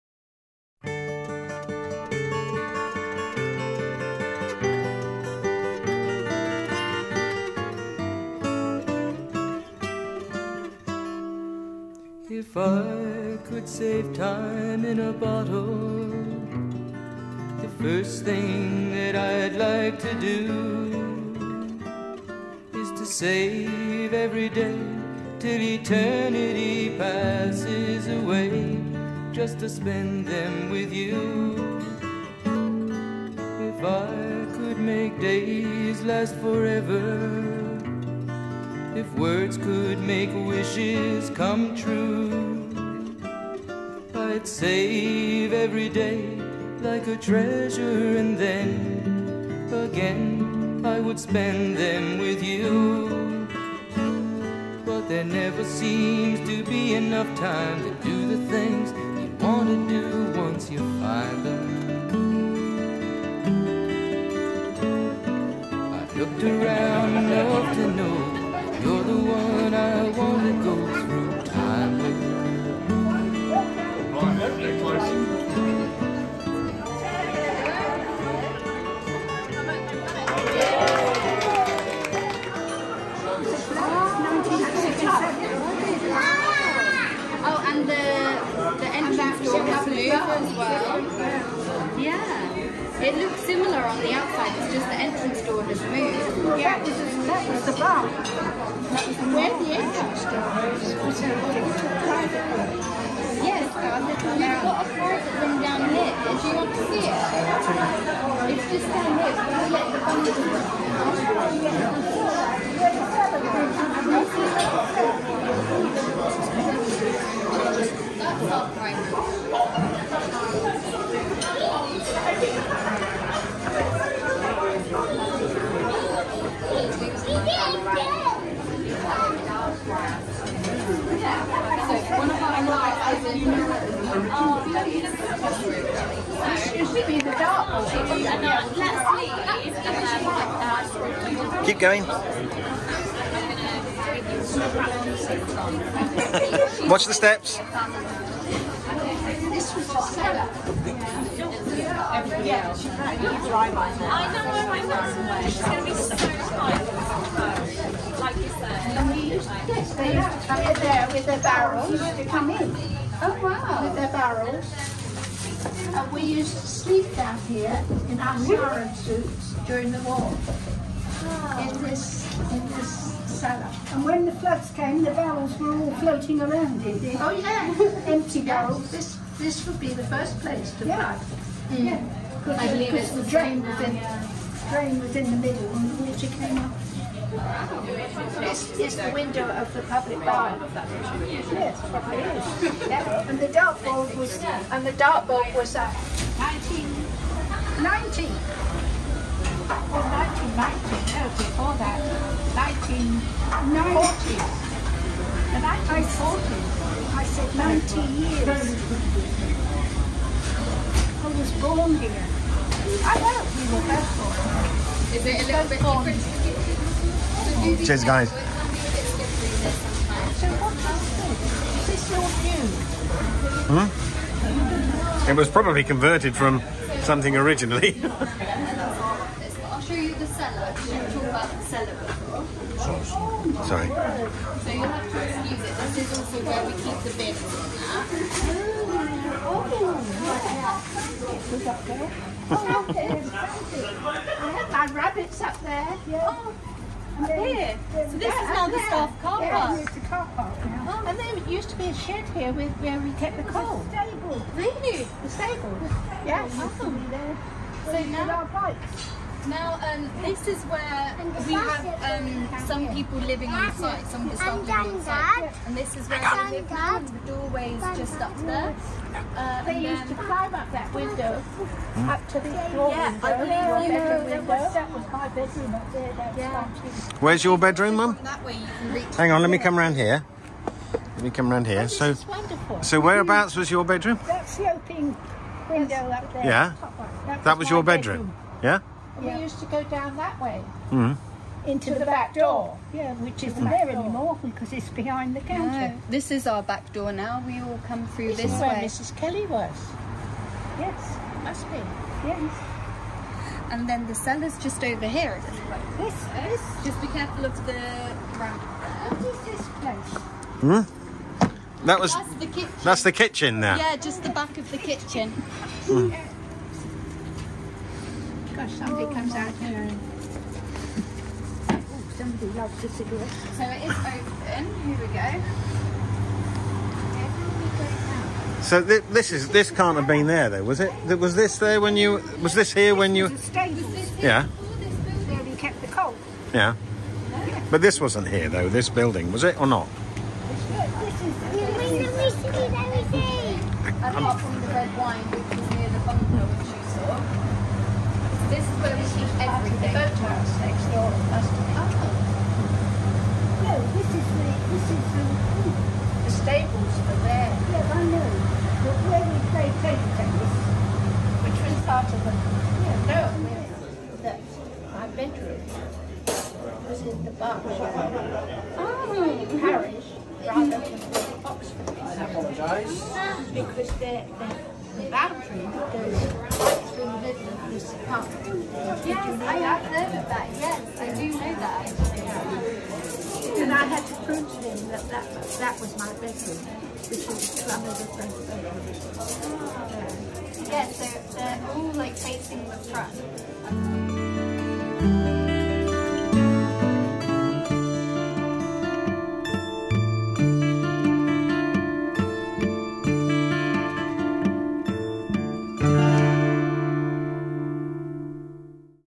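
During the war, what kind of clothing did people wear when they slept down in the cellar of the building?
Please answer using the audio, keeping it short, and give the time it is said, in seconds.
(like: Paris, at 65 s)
siren suits, at 168 s.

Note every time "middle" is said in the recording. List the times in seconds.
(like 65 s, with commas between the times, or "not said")
185 s, 377 s.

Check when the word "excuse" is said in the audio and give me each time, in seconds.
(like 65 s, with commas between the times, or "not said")
235 s.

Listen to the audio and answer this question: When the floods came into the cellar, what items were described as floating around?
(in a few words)
empty barrels.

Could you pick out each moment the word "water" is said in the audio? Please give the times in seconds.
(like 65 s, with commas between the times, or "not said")
186 s.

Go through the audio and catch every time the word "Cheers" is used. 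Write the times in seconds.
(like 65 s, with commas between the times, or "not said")
217 s.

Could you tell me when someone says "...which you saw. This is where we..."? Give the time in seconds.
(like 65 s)
346 s.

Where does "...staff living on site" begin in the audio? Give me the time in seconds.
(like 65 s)
264 s.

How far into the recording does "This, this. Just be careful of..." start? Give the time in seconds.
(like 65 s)
305 s.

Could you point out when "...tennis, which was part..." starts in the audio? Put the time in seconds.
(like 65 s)
360 s.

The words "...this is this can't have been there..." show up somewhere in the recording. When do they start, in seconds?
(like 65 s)
329 s.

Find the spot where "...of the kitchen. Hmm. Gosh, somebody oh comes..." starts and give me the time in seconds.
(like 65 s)
314 s.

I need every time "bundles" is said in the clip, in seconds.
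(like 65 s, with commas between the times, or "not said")
113 s.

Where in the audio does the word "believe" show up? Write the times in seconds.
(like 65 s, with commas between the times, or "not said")
182 s, 273 s.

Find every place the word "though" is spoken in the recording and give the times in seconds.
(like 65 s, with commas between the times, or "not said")
330 s, 338 s.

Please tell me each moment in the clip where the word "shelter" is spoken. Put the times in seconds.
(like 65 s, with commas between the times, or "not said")
not said.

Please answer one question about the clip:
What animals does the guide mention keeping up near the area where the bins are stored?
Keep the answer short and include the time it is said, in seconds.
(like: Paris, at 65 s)
rabbits, at 244 s.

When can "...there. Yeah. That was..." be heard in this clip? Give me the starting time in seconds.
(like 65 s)
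286 s.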